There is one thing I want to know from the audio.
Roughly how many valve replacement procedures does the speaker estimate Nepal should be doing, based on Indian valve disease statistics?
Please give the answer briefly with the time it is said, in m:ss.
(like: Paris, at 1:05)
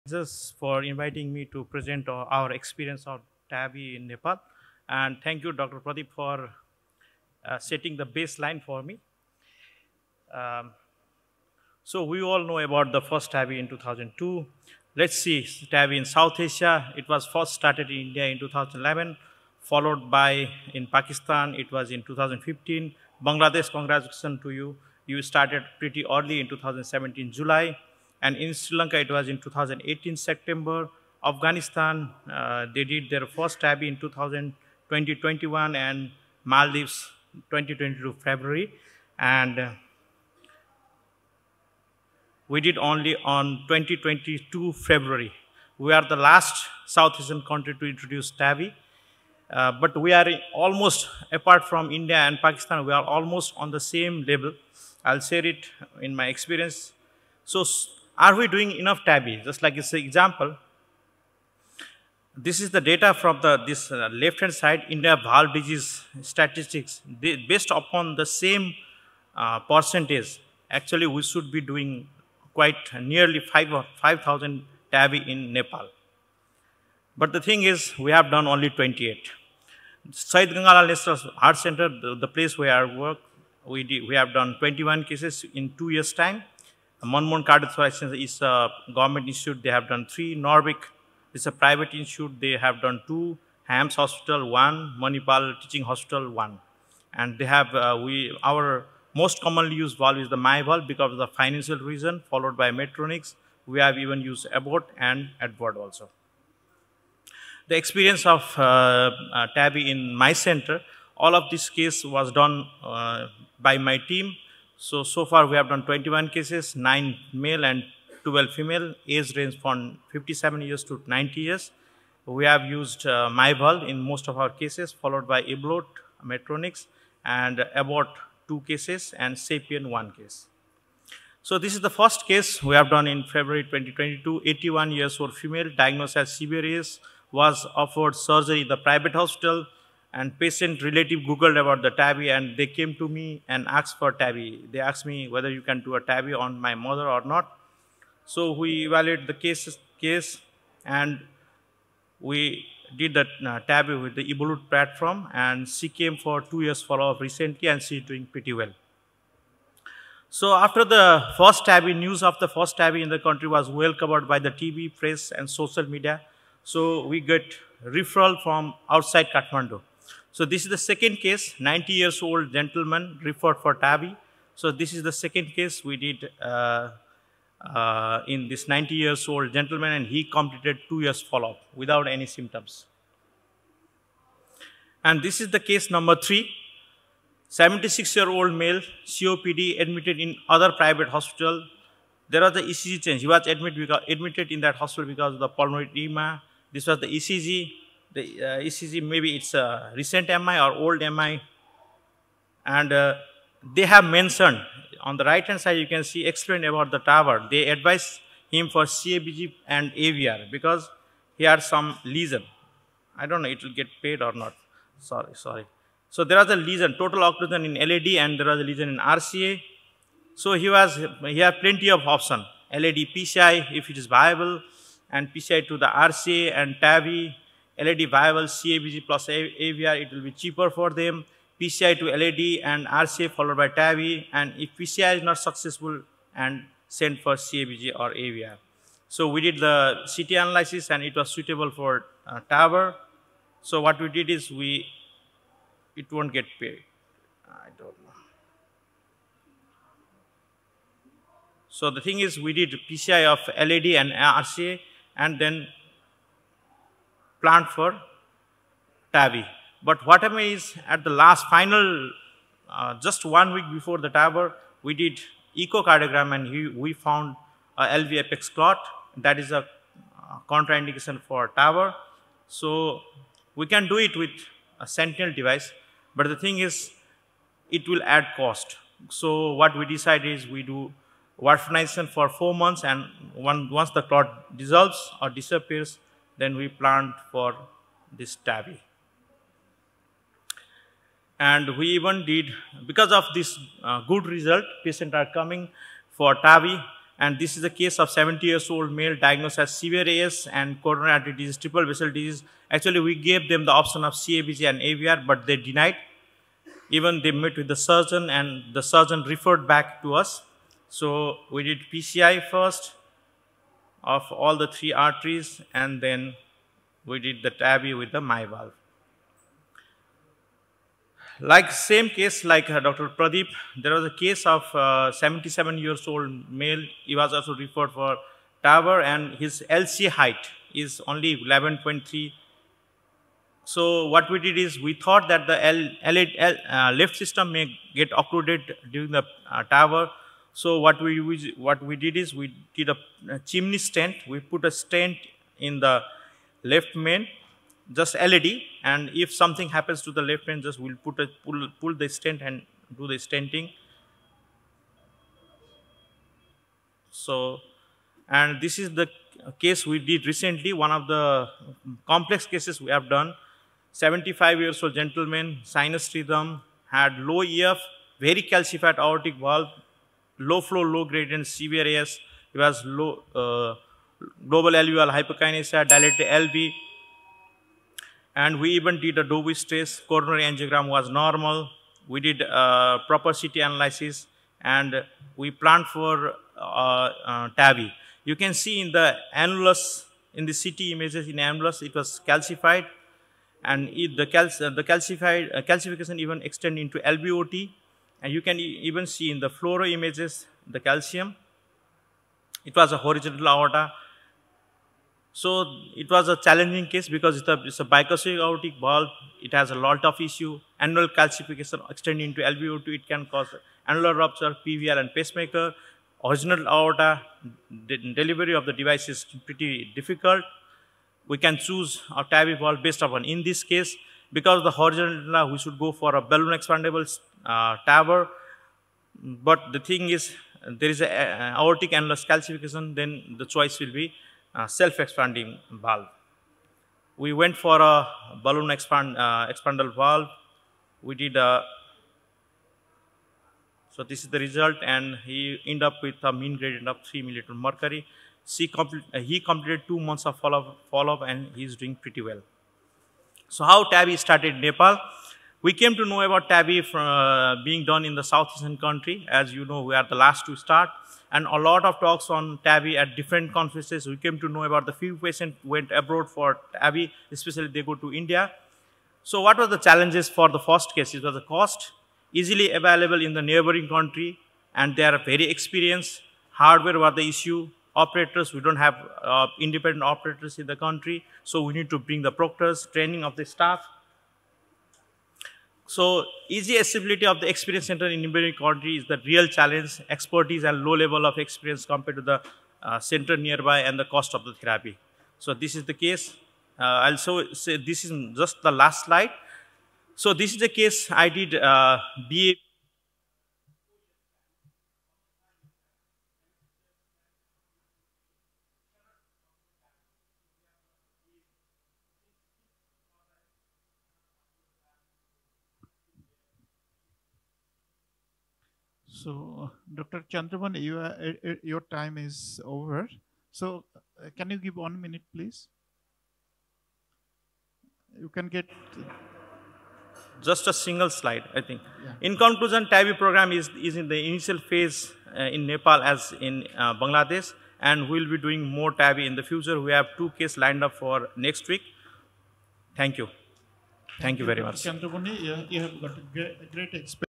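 5000, at 1:13.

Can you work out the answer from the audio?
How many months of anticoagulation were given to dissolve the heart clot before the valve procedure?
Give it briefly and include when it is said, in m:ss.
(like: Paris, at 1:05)
4, at 4:42.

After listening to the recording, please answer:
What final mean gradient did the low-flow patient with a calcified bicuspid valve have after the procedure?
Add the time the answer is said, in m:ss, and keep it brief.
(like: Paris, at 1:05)
3 mmHg, at 7:27.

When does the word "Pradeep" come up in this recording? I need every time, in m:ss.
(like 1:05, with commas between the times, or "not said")
0:05, 5:23.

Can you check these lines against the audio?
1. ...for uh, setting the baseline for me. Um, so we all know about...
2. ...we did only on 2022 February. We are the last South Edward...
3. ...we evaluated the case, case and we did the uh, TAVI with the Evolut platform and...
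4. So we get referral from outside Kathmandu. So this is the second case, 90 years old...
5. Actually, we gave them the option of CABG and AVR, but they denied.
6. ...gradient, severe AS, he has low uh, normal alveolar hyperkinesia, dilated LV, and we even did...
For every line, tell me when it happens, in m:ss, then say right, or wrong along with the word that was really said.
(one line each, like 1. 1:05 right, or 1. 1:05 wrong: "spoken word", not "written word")
1. 0:06 right
2. 0:42 wrong: "Asian", not "Edward"
3. 2:28 right
4. 2:46 right
5. 5:02 right
6. 6:11 wrong: "global", not "normal".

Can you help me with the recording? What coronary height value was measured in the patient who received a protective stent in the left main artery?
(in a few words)
11.3.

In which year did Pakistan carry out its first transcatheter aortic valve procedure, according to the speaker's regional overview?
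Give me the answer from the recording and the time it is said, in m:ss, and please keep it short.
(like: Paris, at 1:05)
2015, at 0:22.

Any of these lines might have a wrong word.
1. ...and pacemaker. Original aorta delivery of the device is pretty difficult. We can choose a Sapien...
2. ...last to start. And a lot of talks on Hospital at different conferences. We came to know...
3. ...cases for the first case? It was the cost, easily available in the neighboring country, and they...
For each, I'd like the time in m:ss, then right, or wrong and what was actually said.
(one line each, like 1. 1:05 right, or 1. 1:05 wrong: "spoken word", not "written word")
1. 6:54 wrong: "TAVI", not "Sapien"
2. 7:40 wrong: "TAVI", not "Hospital"
3. 7:49 wrong: "challenges", not "cases".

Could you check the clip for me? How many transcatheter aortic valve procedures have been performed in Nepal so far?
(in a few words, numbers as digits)
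28.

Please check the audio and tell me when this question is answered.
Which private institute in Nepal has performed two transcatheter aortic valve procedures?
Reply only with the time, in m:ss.
1:30.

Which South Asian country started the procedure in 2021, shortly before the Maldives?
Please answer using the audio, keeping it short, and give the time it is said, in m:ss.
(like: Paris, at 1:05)
Afghanistan, at 0:31.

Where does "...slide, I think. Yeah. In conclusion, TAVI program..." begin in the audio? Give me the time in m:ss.
8:51.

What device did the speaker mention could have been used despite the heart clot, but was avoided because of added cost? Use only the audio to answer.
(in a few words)
Sentinel device.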